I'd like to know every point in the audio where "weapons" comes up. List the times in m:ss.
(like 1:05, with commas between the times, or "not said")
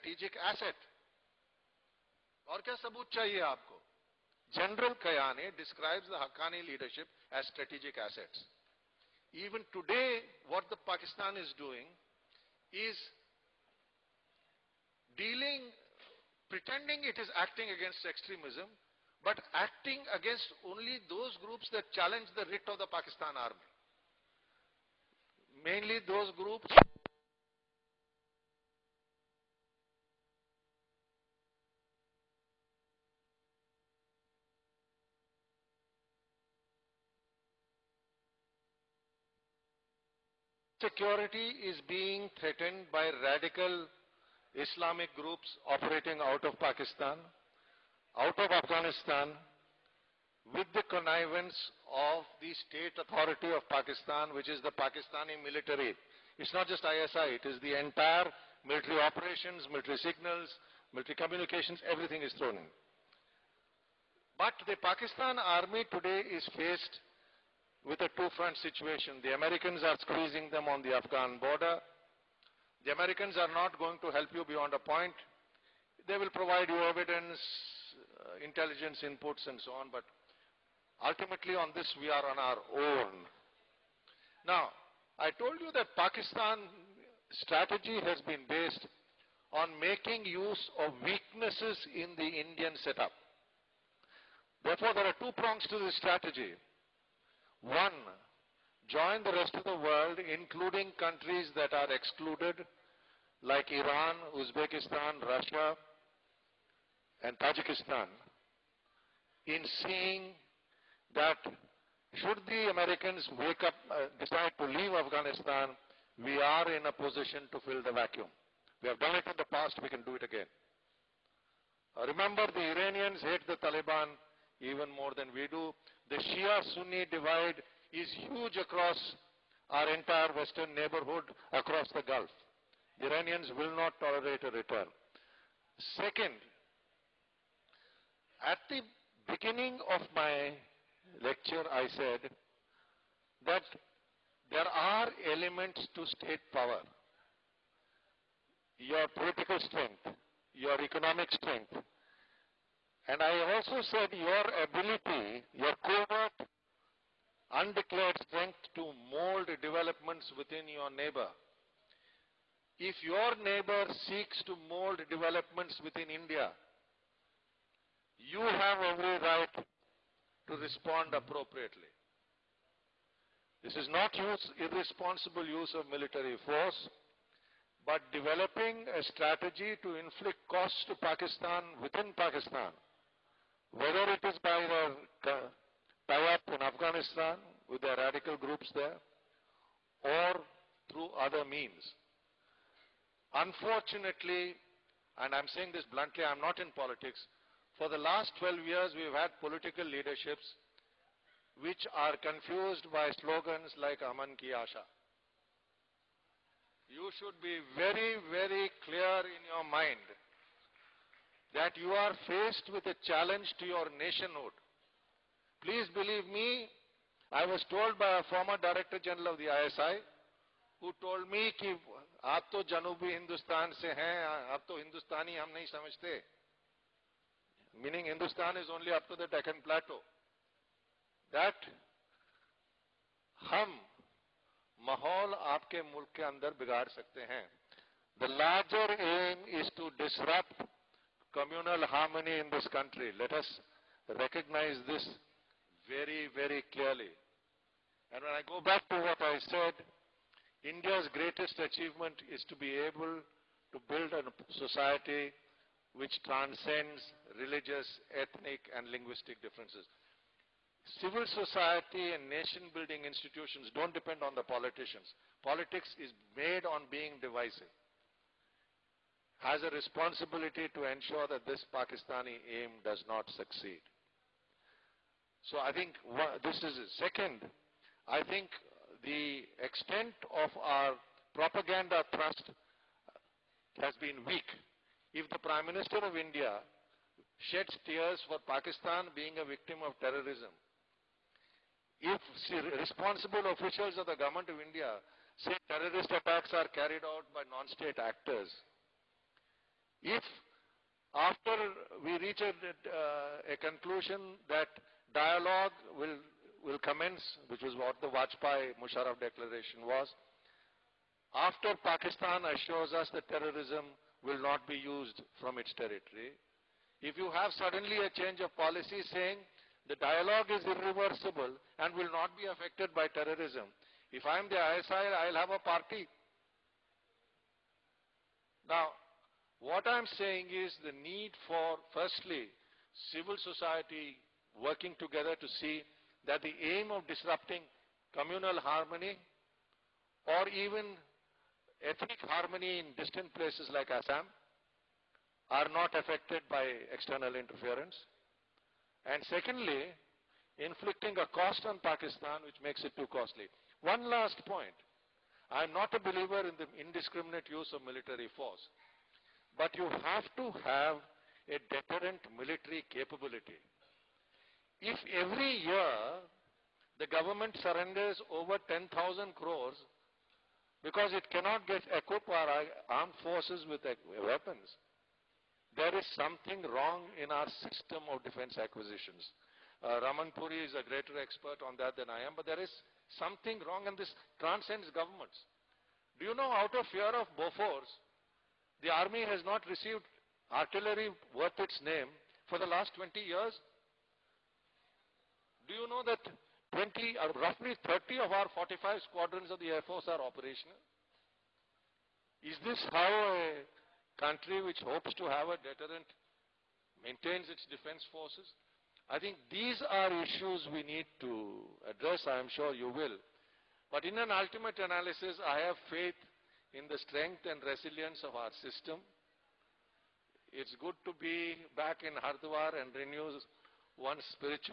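6:14.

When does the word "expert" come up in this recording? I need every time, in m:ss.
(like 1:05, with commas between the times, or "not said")
6:21.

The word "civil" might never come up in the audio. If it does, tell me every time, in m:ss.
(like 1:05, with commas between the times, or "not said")
4:21, 5:33.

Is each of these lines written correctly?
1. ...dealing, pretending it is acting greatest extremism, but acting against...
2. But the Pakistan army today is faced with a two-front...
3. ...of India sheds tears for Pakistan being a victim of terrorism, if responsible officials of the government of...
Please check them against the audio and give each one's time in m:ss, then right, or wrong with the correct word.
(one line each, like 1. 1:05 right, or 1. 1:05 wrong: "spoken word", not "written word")
1. 0:15 wrong: "against", not "greatest"
2. 1:04 right
3. 4:46 right.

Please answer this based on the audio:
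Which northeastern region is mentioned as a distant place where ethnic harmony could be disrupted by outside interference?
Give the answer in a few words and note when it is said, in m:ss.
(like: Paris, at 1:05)
Assam, at 5:43.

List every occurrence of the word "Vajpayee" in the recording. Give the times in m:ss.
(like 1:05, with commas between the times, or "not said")
5:08.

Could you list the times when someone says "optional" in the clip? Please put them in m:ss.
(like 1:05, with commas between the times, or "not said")
not said.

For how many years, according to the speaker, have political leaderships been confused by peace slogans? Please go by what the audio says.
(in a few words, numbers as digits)
12.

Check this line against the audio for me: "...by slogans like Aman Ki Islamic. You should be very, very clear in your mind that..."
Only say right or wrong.
wrong.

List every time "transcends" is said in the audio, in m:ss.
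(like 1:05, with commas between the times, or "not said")
4:16, 6:24.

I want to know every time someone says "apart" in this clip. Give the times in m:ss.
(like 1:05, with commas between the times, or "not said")
not said.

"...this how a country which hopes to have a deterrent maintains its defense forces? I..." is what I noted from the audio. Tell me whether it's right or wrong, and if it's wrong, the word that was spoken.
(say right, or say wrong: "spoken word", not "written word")
right.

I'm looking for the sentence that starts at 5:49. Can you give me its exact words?
And secondly, inflicting a cost on Pakistan which makes it too costly.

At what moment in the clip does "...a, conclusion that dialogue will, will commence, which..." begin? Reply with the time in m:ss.
5:03.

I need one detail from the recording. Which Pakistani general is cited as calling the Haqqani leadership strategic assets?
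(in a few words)
General Kayani.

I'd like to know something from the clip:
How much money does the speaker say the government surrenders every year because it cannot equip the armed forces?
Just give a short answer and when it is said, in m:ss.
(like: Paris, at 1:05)
10,000 crores, at 6:08.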